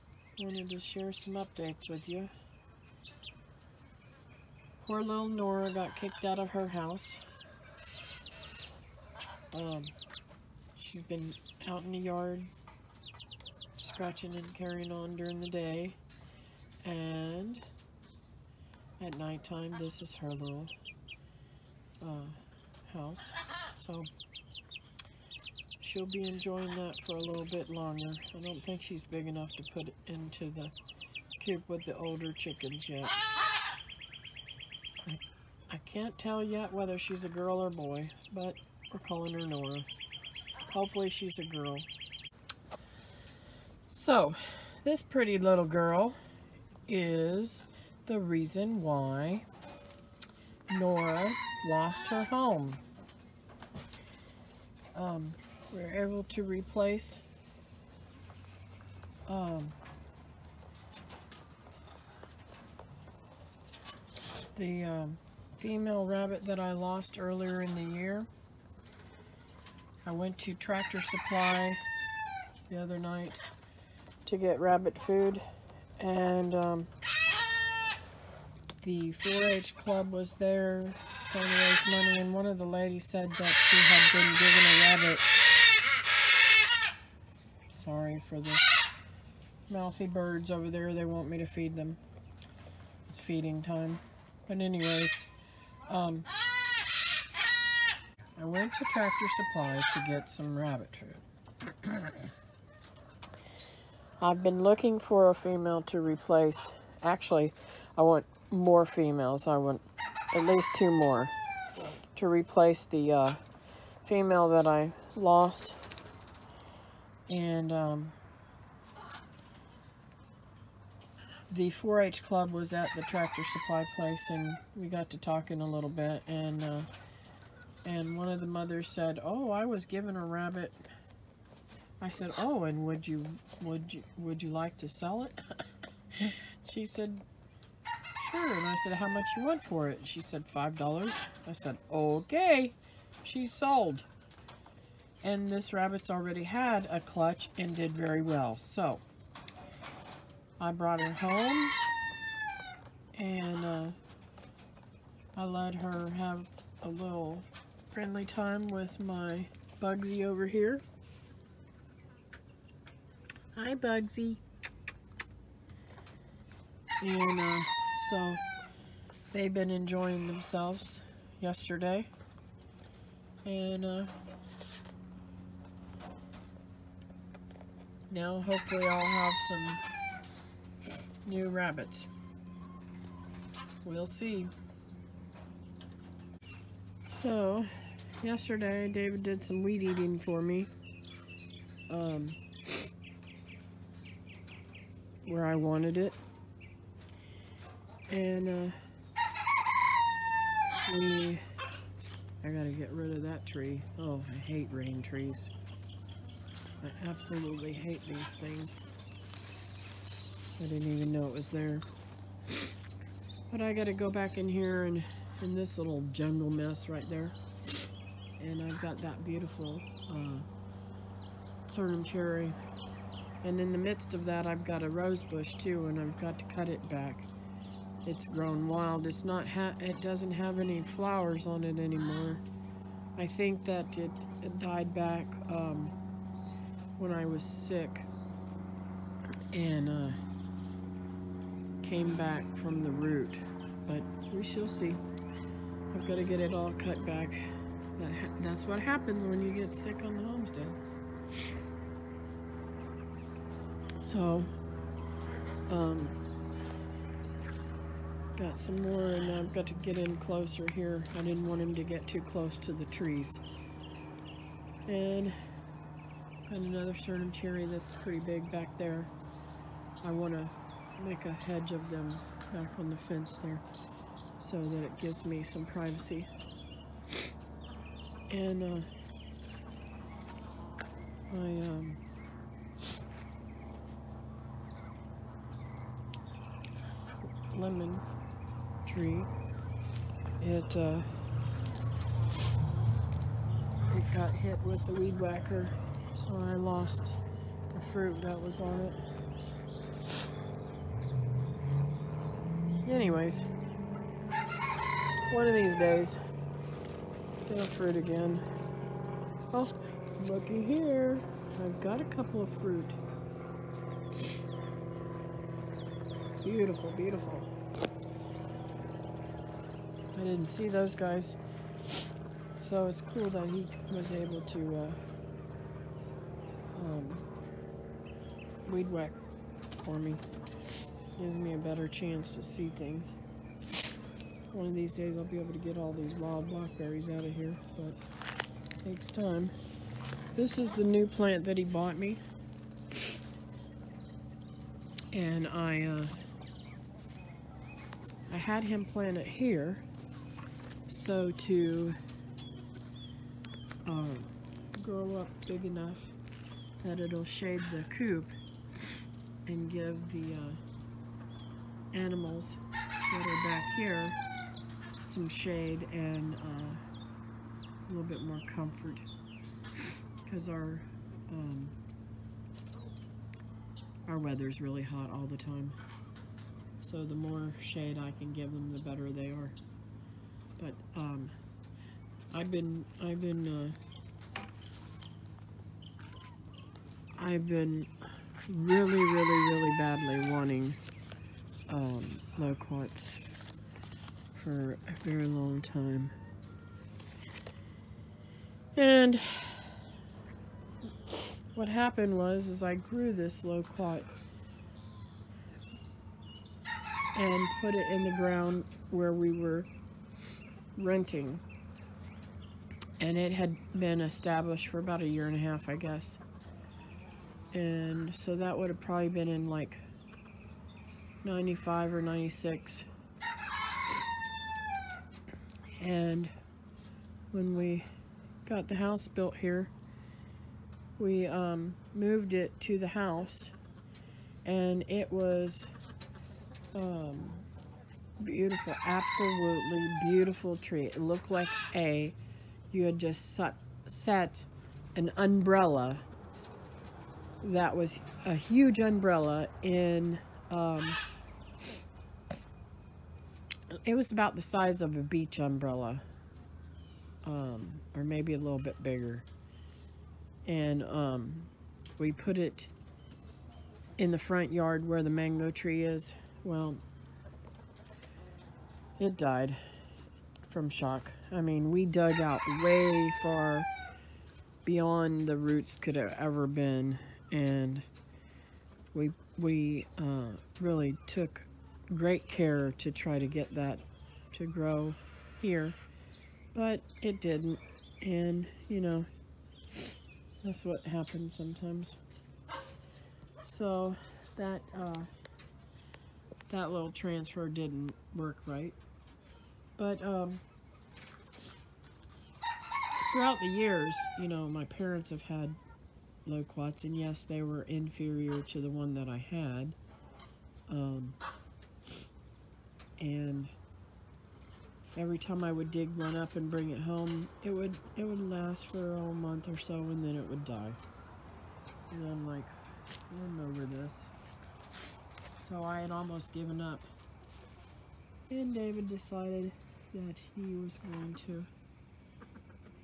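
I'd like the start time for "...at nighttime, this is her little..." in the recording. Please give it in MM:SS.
00:18.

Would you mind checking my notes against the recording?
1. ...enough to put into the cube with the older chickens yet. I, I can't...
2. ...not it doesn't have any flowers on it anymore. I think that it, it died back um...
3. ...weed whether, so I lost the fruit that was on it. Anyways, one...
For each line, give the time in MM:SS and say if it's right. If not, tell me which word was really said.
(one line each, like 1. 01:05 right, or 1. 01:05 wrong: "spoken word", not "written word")
1. 00:29 right
2. 03:49 right
3. 04:54 wrong: "whacker", not "whether".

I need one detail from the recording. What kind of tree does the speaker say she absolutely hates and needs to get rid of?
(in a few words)
Rain trees.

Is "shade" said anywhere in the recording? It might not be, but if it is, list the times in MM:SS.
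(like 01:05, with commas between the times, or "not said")
05:57, 06:05, 06:17.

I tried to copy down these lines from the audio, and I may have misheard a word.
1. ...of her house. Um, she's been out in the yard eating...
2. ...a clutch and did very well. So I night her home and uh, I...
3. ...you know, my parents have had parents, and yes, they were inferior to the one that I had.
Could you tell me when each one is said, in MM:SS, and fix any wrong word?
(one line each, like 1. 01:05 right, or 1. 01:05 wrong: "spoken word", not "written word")
1. 00:06 wrong: "scratching", not "eating"
2. 02:26 wrong: "brought", not "night"
3. 08:24 wrong: "loquats", not "parents".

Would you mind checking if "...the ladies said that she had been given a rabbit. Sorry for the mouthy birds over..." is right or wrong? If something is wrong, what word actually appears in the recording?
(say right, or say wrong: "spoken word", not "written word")
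right.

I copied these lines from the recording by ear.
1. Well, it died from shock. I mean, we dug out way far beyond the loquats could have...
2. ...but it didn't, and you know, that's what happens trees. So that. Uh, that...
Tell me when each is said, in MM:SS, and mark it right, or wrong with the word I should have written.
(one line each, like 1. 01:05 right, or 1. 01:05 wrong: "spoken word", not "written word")
1. 07:46 wrong: "roots", not "loquats"
2. 08:06 wrong: "sometimes", not "trees".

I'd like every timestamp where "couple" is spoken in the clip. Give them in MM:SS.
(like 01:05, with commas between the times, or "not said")
05:12.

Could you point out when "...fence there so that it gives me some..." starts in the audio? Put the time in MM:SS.
04:32.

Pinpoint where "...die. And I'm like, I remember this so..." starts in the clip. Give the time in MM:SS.
08:40.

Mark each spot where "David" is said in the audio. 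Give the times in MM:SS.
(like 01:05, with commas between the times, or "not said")
03:08, 08:48.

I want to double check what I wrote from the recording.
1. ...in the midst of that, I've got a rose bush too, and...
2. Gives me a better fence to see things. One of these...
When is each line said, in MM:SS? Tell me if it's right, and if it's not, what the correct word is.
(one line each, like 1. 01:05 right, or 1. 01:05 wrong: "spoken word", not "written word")
1. 03:43 right
2. 05:31 wrong: "chance", not "fence".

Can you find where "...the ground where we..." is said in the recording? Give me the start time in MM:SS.
06:48.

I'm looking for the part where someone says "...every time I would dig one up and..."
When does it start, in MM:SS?
08:34.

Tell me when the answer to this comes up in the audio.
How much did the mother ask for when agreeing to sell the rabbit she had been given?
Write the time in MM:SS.
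02:20.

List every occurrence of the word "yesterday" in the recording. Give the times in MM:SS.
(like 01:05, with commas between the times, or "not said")
02:51, 03:08.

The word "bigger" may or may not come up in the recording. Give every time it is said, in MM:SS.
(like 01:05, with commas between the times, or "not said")
07:38.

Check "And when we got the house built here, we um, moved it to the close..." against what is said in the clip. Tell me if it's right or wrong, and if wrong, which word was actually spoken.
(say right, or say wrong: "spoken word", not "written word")
wrong: "house", not "close".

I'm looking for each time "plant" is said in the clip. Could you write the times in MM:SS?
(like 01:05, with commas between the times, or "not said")
05:41, 05:48.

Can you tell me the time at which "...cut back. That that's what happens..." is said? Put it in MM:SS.
04:06.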